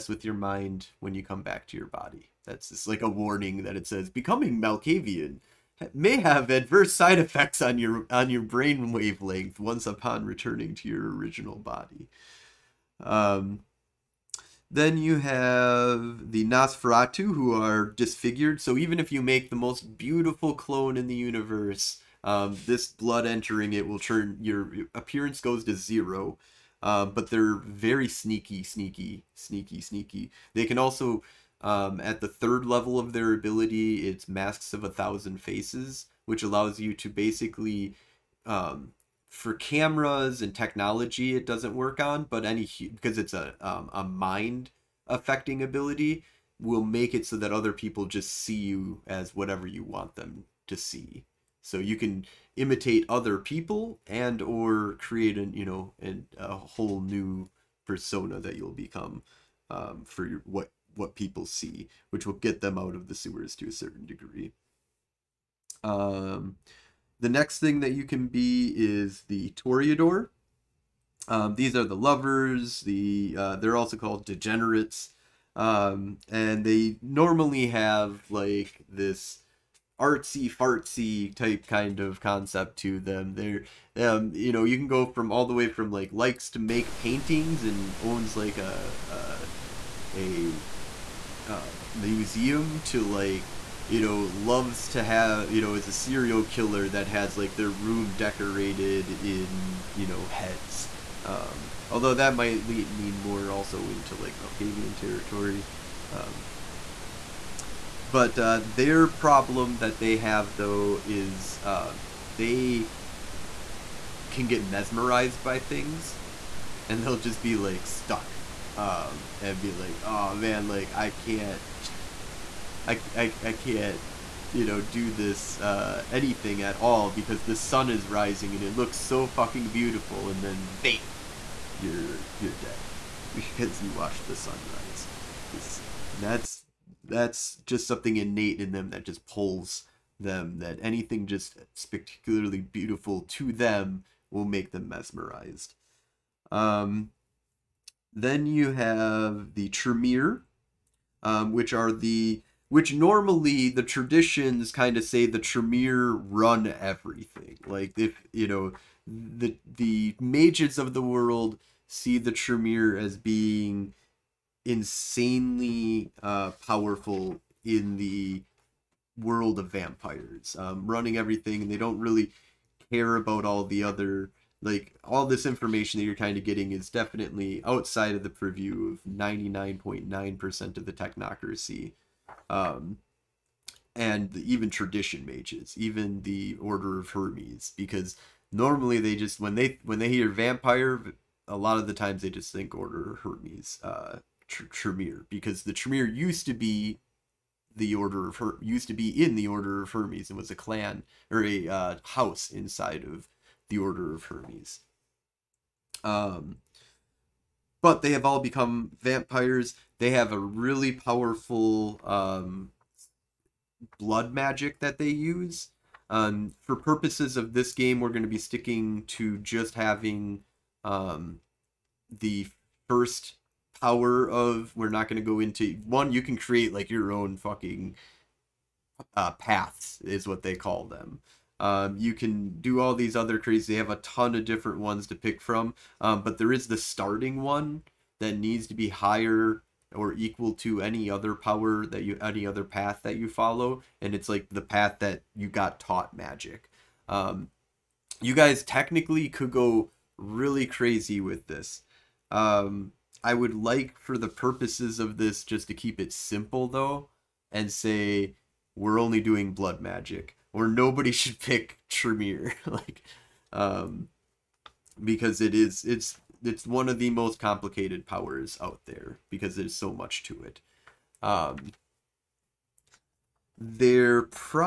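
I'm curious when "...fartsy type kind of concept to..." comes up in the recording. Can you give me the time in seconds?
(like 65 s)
80 s.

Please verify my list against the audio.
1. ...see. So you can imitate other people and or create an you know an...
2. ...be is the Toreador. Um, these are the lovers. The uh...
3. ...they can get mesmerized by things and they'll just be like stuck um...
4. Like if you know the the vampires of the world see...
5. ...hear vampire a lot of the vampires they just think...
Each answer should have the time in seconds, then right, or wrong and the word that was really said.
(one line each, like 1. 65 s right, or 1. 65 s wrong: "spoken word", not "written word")
1. 50 s right
2. 68 s right
3. 112 s right
4. 157 s wrong: "mages", not "vampires"
5. 190 s wrong: "times", not "vampires".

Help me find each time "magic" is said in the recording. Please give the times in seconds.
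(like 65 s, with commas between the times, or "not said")
214 s, 246 s, 259 s.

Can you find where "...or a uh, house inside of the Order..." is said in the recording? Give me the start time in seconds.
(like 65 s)
201 s.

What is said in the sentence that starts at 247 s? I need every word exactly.
Um, you guys technically could go really crazy with this.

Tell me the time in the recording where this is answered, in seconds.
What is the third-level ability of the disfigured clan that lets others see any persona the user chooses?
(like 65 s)
34 s.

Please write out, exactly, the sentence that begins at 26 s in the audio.
Uh, but they're very sneaky, sneaky, sneaky, sneaky.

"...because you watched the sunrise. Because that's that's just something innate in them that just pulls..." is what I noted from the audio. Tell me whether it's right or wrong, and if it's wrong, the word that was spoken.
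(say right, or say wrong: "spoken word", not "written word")
right.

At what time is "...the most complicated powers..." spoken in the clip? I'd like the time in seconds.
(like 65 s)
266 s.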